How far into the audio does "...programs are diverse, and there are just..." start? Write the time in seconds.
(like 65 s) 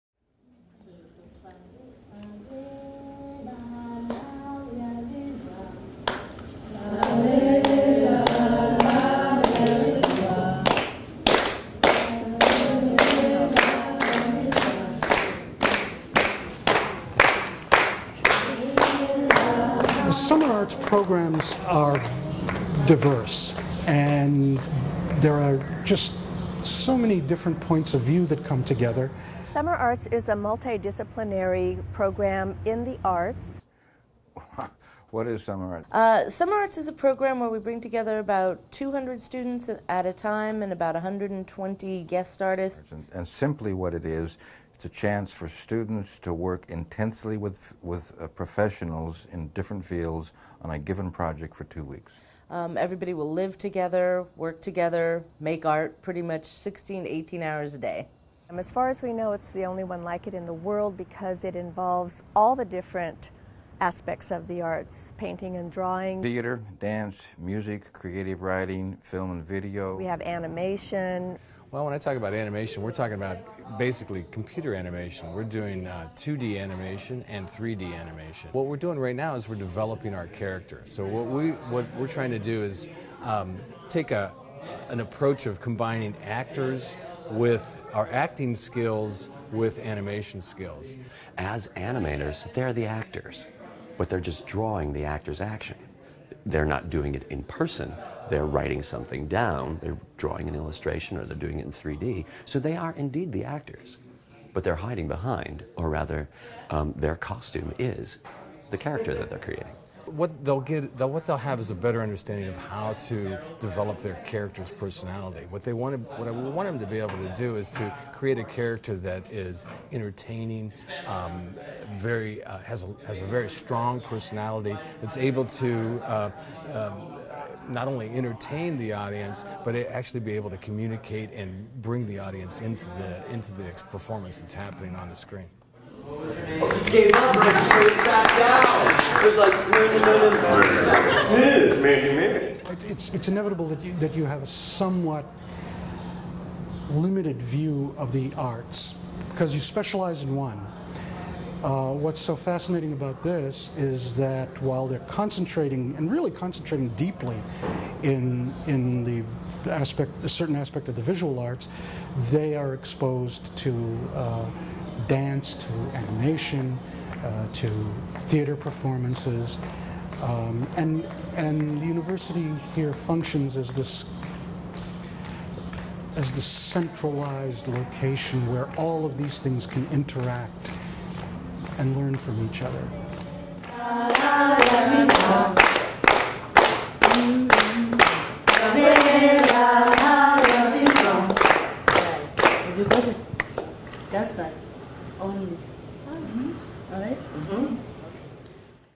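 20 s.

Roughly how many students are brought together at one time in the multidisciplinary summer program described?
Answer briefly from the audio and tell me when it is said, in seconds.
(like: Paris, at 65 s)
200, at 38 s.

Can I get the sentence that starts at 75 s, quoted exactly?
We're doing uh, 2D animation and 3D animation.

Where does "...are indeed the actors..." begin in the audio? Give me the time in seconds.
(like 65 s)
102 s.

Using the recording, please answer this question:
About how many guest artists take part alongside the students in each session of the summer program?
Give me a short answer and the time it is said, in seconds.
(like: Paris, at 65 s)
120, at 40 s.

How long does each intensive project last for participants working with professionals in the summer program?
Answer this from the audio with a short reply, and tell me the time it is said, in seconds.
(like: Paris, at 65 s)
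2 weeks, at 51 s.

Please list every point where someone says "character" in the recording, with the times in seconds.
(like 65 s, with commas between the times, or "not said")
80 s, 108 s, 114 s, 118 s.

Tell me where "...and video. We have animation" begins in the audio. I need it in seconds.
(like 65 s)
69 s.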